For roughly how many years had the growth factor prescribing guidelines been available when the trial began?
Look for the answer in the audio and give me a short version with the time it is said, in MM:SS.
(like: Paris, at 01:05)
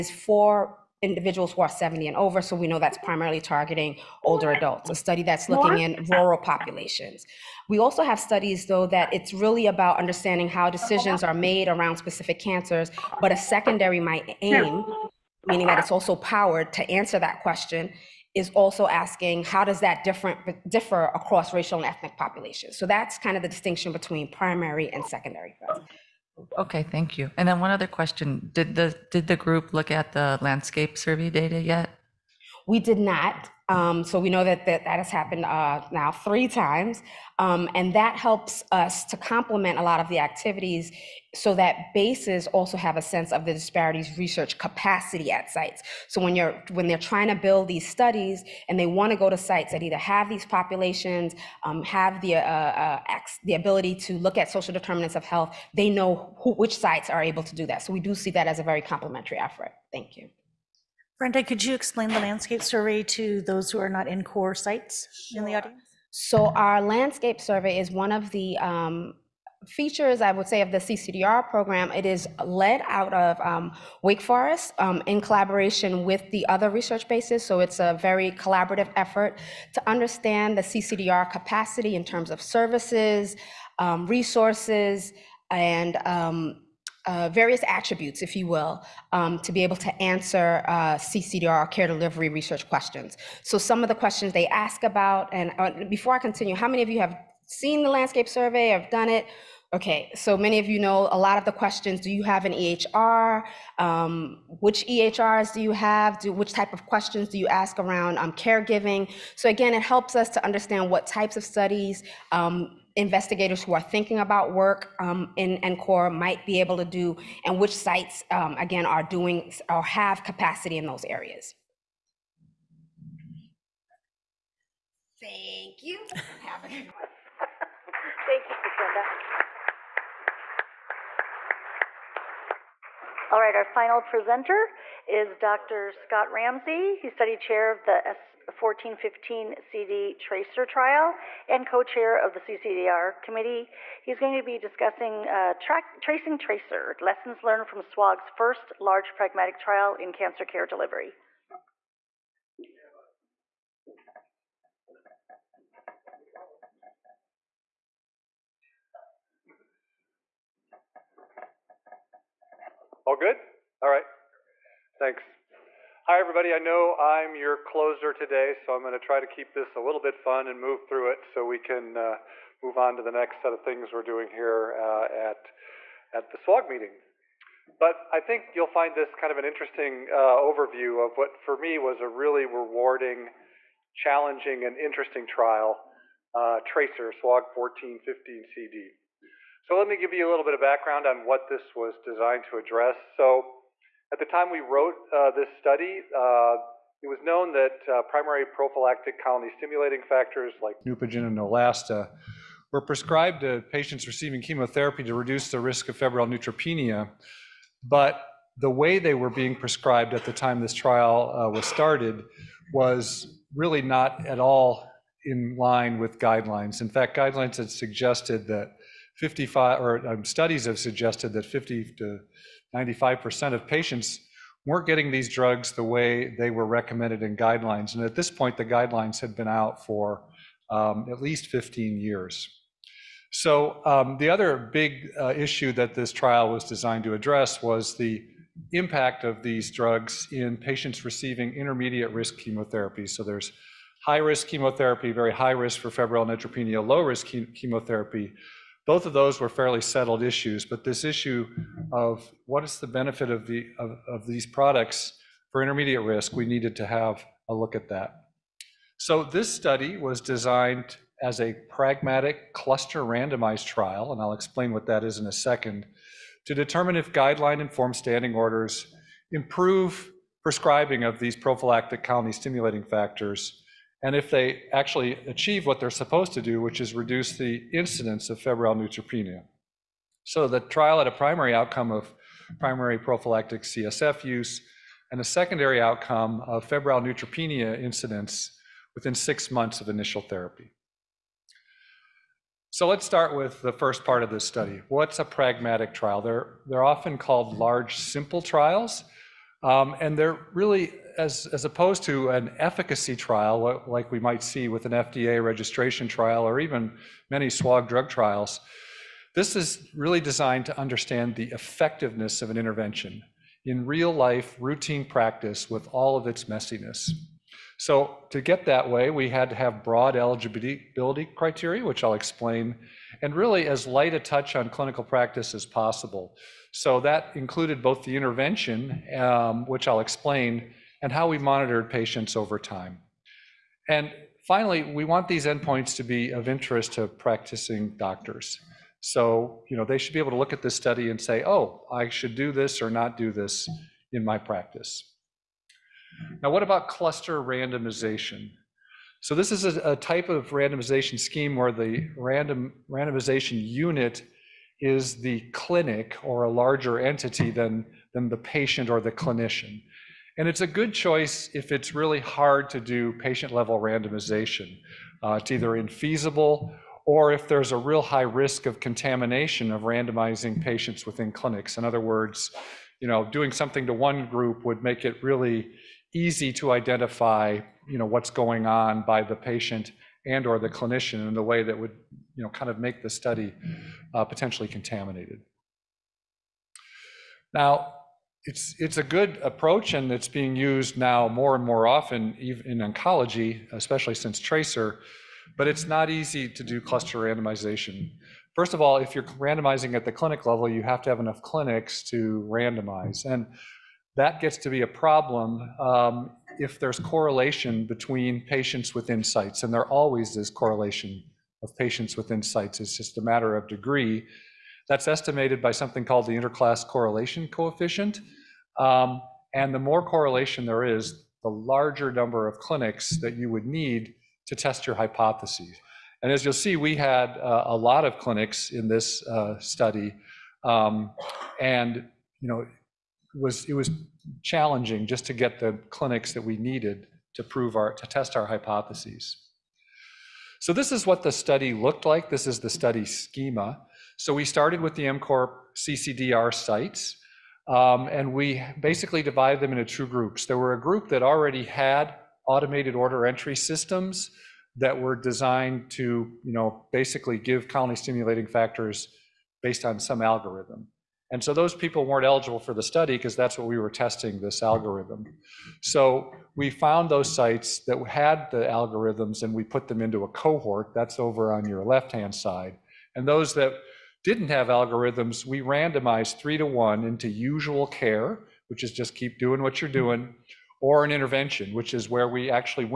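15, at 03:51.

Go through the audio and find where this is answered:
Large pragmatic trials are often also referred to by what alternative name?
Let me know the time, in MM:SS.
04:57.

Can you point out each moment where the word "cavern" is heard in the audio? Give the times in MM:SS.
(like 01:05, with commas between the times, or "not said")
not said.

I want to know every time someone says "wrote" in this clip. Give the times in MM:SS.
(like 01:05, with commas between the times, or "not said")
03:14.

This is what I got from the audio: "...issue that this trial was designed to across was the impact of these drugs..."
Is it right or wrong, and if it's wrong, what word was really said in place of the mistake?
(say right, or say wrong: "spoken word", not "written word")
wrong: "address", not "across".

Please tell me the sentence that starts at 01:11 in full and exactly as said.
It is led out of um, Wake Forest um, in collaboration with the other research bases.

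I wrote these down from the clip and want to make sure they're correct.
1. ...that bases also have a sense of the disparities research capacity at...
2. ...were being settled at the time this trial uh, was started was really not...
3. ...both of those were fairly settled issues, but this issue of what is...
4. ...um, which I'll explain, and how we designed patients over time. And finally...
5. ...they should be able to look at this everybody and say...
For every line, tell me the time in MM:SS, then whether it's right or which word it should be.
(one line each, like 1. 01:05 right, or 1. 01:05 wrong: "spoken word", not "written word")
1. 00:41 right
2. 03:29 wrong: "prescribed", not "settled"
3. 04:08 right
4. 05:29 wrong: "monitored", not "designed"
5. 05:39 wrong: "study", not "everybody".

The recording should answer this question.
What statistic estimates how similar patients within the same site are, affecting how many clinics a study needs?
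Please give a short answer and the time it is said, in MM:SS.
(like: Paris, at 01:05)
interclass correlation coefficient, at 06:56.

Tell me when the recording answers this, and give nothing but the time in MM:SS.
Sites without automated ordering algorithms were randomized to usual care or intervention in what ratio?
07:56.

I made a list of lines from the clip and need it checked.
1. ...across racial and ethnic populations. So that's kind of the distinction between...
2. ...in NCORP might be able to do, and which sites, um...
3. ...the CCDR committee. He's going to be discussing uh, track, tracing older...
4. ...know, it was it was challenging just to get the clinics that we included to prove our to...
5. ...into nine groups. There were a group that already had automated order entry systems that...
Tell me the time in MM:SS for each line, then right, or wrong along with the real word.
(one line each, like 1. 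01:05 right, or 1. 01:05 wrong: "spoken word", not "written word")
1. 00:21 right
2. 01:55 right
3. 02:22 wrong: "tracer", not "older"
4. 07:12 wrong: "needed", not "included"
5. 07:29 wrong: "two", not "nine".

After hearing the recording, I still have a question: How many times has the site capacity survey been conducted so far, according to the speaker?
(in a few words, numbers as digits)
3.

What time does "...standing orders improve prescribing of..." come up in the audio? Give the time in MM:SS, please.
04:27.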